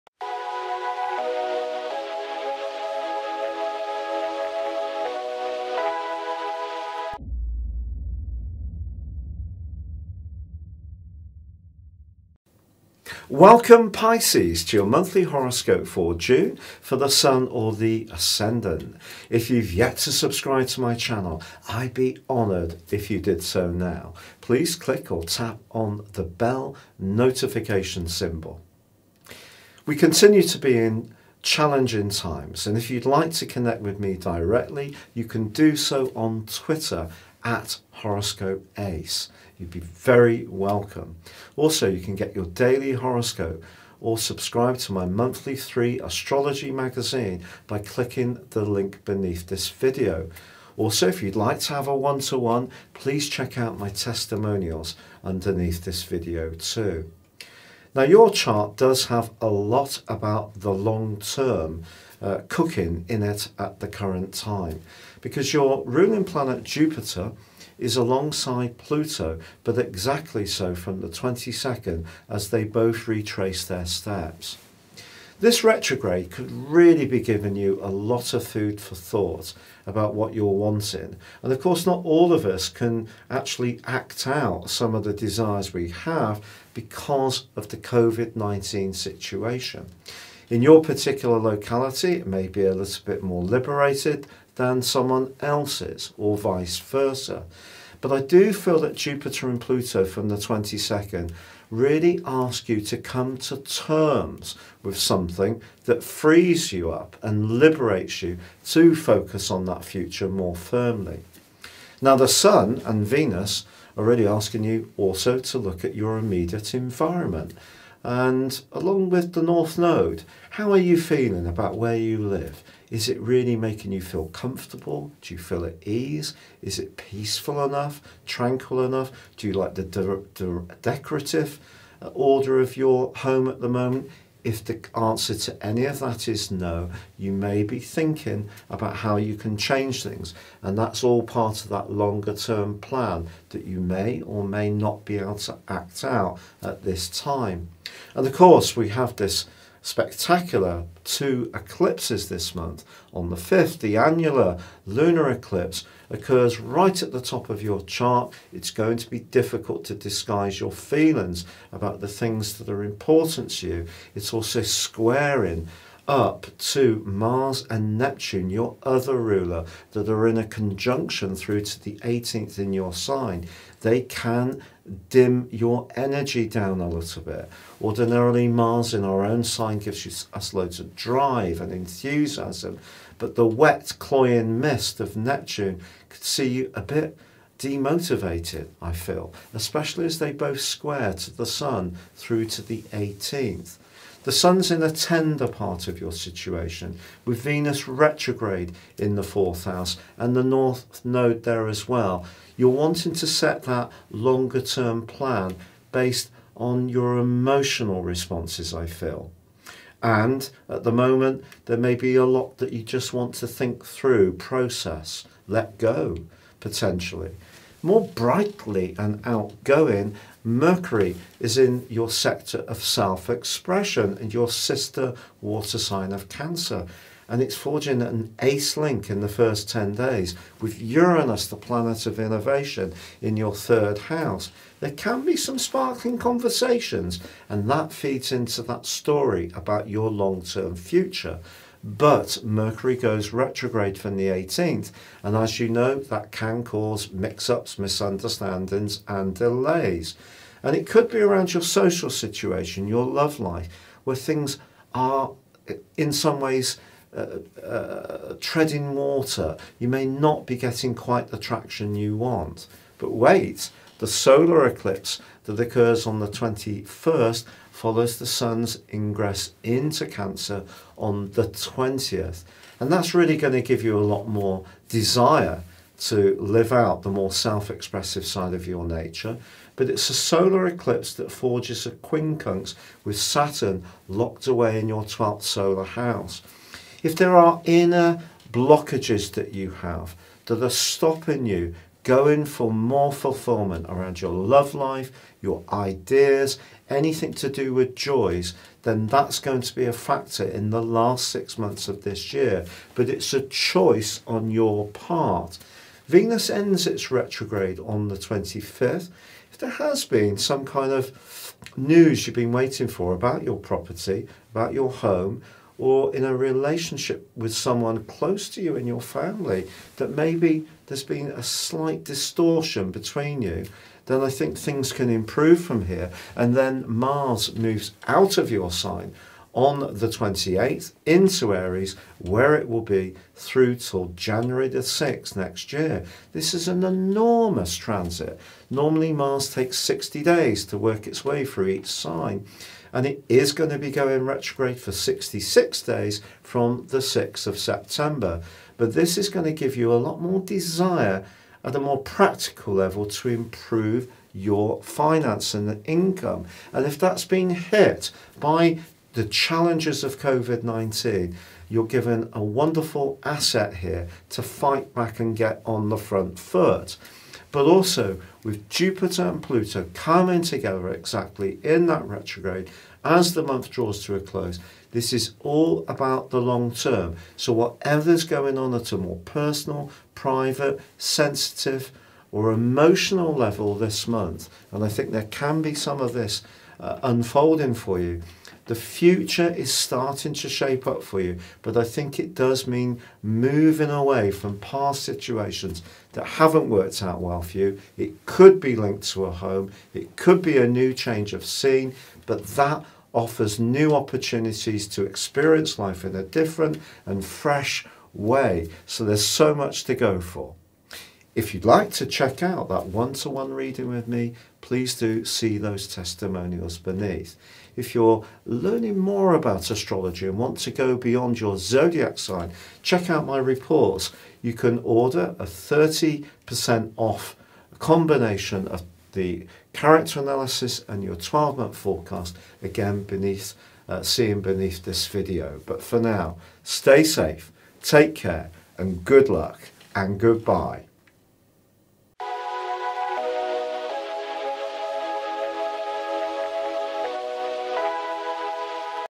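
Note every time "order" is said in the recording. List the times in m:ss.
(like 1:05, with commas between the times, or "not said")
2:12, 7:04.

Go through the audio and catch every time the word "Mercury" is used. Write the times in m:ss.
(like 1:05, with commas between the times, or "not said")
3:40, 4:02.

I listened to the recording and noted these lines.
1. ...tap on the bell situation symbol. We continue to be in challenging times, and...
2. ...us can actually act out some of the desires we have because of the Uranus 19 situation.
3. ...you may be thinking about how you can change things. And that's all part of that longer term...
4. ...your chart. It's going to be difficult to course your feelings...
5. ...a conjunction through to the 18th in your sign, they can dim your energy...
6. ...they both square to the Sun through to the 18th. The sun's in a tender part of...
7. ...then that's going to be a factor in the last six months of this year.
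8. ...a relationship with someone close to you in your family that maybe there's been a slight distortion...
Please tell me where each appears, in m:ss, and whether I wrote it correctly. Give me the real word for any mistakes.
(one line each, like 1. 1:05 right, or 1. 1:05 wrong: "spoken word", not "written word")
1. 0:25 wrong: "notification", not "situation"
2. 1:22 wrong: "COVID", not "Uranus"
3. 2:17 right
4. 2:37 wrong: "disguise", not "course"
5. 2:50 right
6. 3:10 right
7. 4:58 right
8. 5:16 right.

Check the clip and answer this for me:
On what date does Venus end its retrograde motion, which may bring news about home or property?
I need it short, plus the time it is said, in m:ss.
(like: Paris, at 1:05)
25th, at 5:08.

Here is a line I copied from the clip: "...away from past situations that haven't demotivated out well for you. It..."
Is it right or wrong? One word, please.
wrong.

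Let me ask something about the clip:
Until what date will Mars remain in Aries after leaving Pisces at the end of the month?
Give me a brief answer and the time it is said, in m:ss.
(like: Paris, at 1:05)
January 6, at 5:34.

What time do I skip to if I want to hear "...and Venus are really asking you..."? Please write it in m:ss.
1:52.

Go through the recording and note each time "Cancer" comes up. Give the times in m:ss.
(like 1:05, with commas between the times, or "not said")
3:46, 4:30.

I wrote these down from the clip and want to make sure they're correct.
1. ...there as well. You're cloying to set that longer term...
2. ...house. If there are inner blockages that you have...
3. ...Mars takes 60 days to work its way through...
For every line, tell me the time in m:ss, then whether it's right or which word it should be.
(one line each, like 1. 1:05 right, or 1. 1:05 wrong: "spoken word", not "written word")
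1. 3:21 wrong: "wanting", not "cloying"
2. 4:45 right
3. 5:39 right.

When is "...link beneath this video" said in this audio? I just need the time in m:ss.
0:48.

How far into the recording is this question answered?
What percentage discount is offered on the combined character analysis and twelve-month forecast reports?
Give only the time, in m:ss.
7:05.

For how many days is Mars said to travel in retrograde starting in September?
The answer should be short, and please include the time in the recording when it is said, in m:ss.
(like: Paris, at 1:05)
66, at 5:44.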